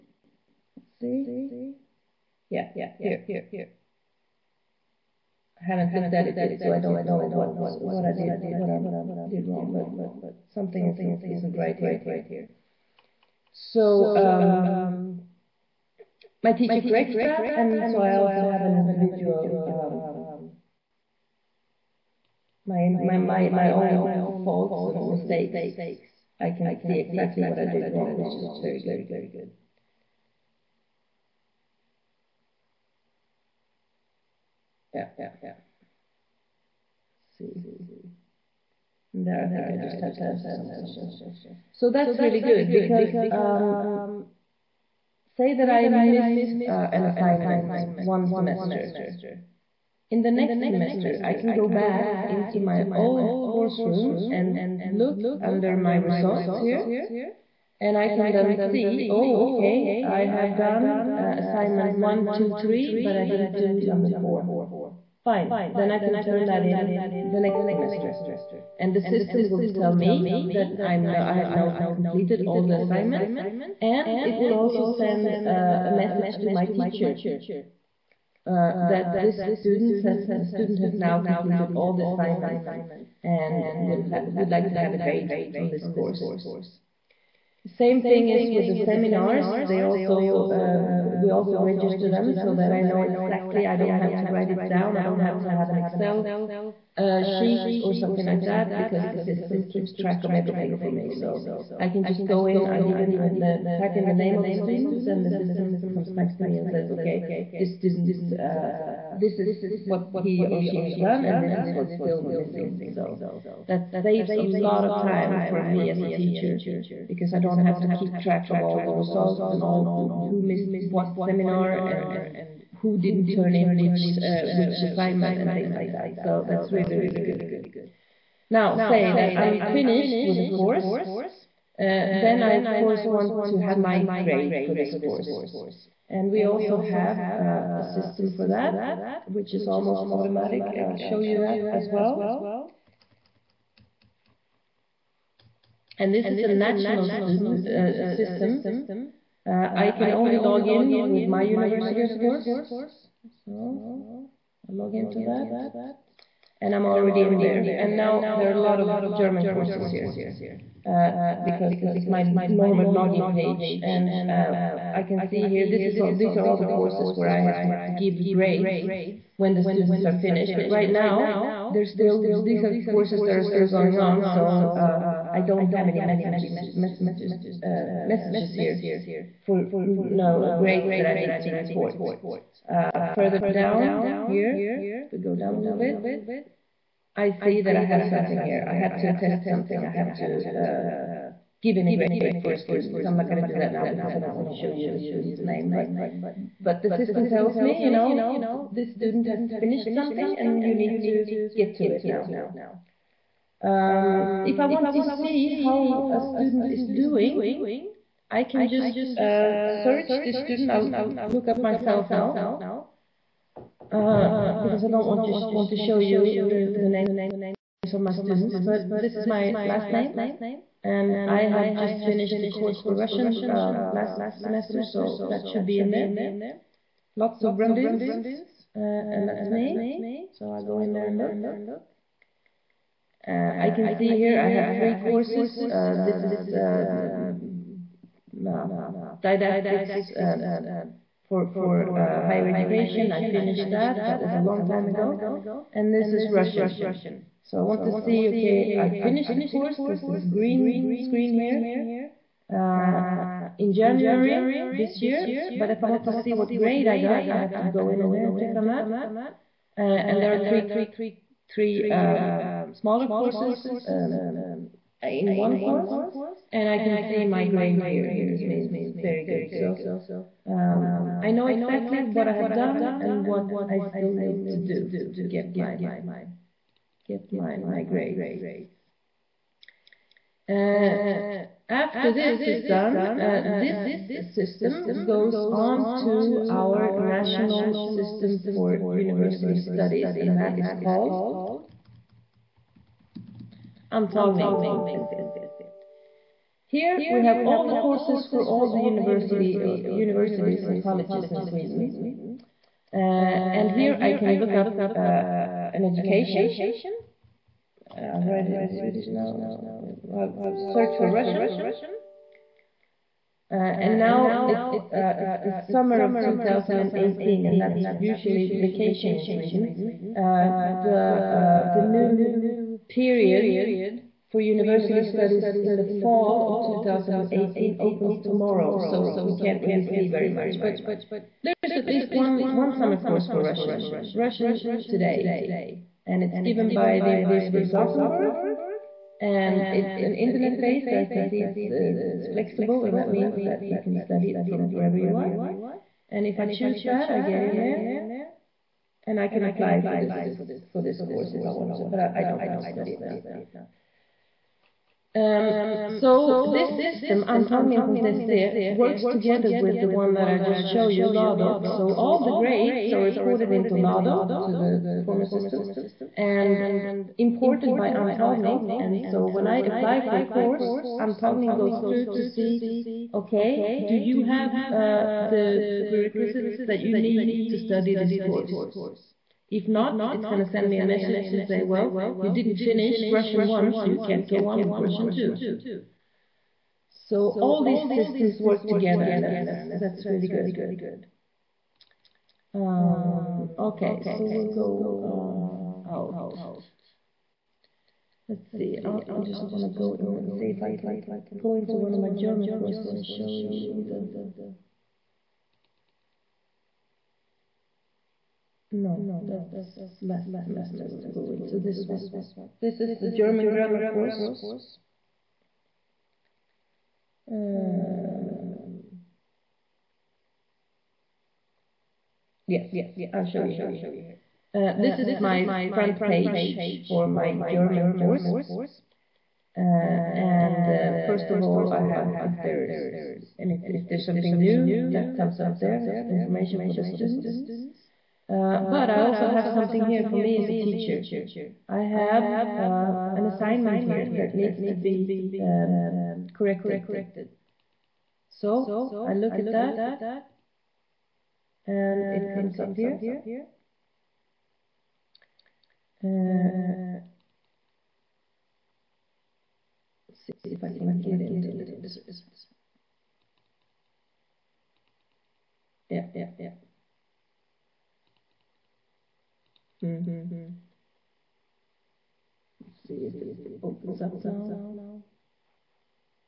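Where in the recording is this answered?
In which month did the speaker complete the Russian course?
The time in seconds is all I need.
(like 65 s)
253 s.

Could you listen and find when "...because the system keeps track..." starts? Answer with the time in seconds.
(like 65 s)
98 s.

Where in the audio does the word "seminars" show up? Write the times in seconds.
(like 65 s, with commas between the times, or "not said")
88 s, 121 s.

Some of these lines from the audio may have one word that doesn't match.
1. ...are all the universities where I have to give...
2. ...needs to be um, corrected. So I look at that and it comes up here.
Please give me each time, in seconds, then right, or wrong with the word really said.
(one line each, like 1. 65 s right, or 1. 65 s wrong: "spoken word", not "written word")
1. 166 s wrong: "courses", not "universities"
2. 444 s right.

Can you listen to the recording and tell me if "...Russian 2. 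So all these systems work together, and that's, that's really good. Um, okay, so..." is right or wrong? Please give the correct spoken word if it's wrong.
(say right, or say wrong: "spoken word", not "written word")
right.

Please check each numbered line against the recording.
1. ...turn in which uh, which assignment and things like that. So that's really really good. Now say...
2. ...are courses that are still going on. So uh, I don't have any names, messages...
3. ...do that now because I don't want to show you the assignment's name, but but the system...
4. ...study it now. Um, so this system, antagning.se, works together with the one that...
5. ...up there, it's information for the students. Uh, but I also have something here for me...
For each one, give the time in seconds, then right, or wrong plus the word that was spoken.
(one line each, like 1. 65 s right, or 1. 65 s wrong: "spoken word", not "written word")
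1. 123 s right
2. 172 s wrong: "messages", not "names"
3. 193 s wrong: "student", not "assignment"
4. 352 s right
5. 435 s right.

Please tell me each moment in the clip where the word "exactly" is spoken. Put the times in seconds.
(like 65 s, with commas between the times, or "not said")
27 s, 93 s, 271 s.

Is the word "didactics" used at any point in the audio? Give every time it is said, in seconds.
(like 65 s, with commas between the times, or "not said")
239 s.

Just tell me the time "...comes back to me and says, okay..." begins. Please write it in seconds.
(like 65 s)
105 s.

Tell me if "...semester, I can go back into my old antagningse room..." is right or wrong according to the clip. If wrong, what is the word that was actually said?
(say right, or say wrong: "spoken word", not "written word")
wrong: "course", not "antagningse".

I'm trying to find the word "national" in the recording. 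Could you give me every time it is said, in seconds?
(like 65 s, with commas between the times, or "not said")
146 s, 286 s.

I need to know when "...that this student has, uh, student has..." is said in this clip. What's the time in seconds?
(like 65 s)
78 s.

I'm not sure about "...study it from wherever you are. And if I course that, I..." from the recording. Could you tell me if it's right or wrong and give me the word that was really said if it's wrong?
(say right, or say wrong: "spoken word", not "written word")
wrong: "choose", not "course".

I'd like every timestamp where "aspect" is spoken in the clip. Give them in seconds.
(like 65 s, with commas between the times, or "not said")
not said.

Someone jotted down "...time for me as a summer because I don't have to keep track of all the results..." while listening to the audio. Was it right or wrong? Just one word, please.
wrong.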